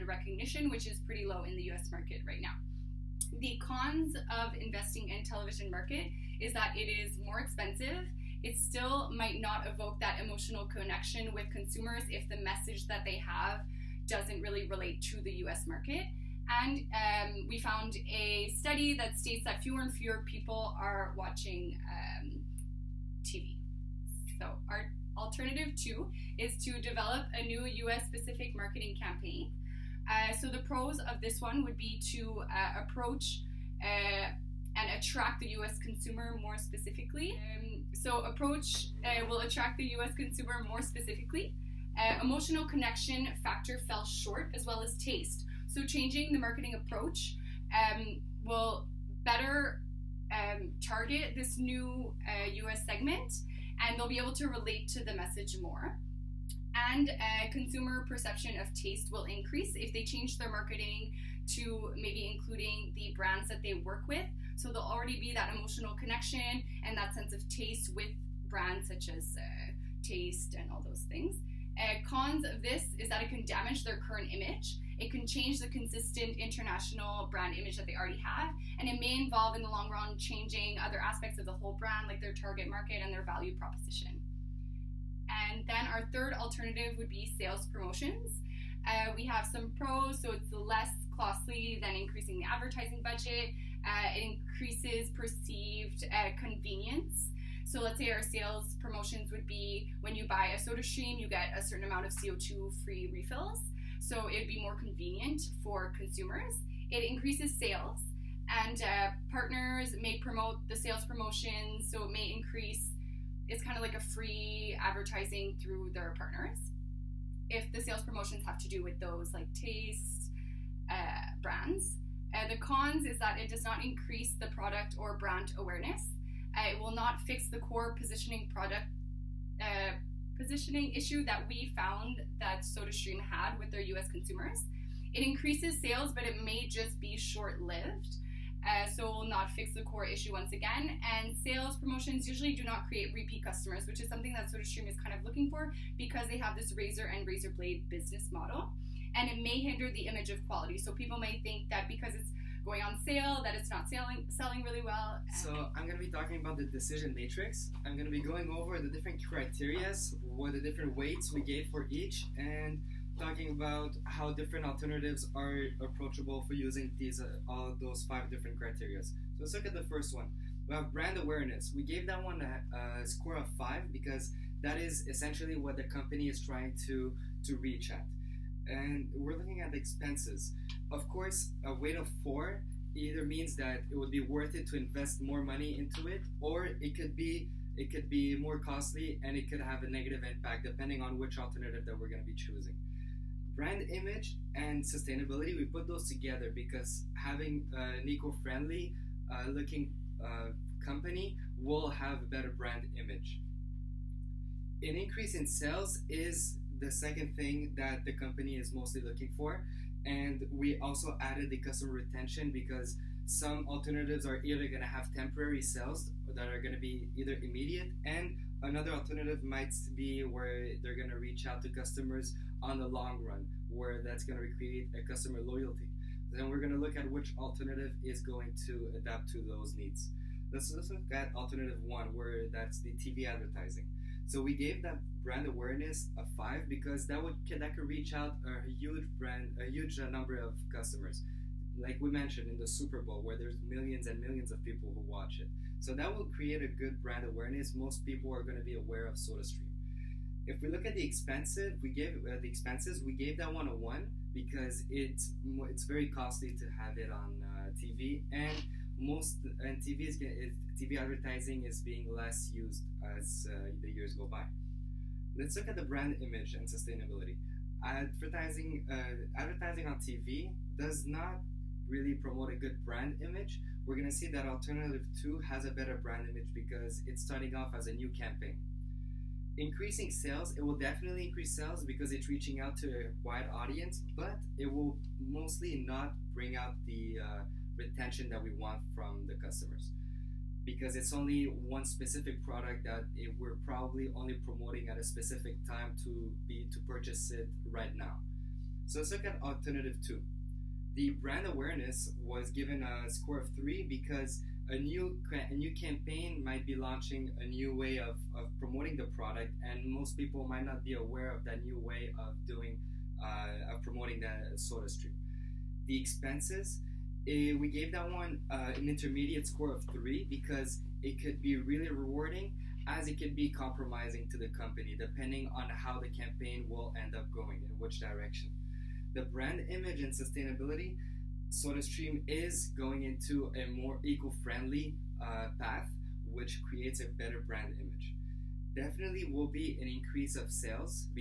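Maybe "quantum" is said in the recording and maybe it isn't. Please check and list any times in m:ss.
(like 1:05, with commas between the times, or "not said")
not said.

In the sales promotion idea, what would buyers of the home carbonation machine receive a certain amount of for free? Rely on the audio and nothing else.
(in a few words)
CO2 refills.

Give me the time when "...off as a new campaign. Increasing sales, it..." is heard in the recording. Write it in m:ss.
4:37.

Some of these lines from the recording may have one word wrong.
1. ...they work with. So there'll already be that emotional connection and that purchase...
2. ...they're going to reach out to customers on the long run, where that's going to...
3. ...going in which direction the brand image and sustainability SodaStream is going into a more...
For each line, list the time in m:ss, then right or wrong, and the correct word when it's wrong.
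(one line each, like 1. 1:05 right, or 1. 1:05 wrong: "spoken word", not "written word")
1. 1:03 wrong: "sense", not "purchase"
2. 3:40 right
3. 5:27 right.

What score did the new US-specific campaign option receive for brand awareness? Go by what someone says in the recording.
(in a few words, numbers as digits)
3.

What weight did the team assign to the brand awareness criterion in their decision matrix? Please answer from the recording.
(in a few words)
5.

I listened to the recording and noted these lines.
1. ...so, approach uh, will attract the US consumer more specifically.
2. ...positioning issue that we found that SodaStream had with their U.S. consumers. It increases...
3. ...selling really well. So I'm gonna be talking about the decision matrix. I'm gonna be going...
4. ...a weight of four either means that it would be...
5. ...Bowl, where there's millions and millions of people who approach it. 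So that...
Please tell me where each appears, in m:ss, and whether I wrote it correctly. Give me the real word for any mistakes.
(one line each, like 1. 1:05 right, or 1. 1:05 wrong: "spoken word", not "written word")
1. 0:37 right
2. 2:10 right
3. 2:34 right
4. 3:01 right
5. 4:03 wrong: "watch", not "approach".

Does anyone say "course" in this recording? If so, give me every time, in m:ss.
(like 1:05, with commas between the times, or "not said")
3:01.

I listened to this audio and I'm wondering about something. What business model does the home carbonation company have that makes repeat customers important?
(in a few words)
razor and razor blade.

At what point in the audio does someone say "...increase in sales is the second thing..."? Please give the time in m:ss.
3:24.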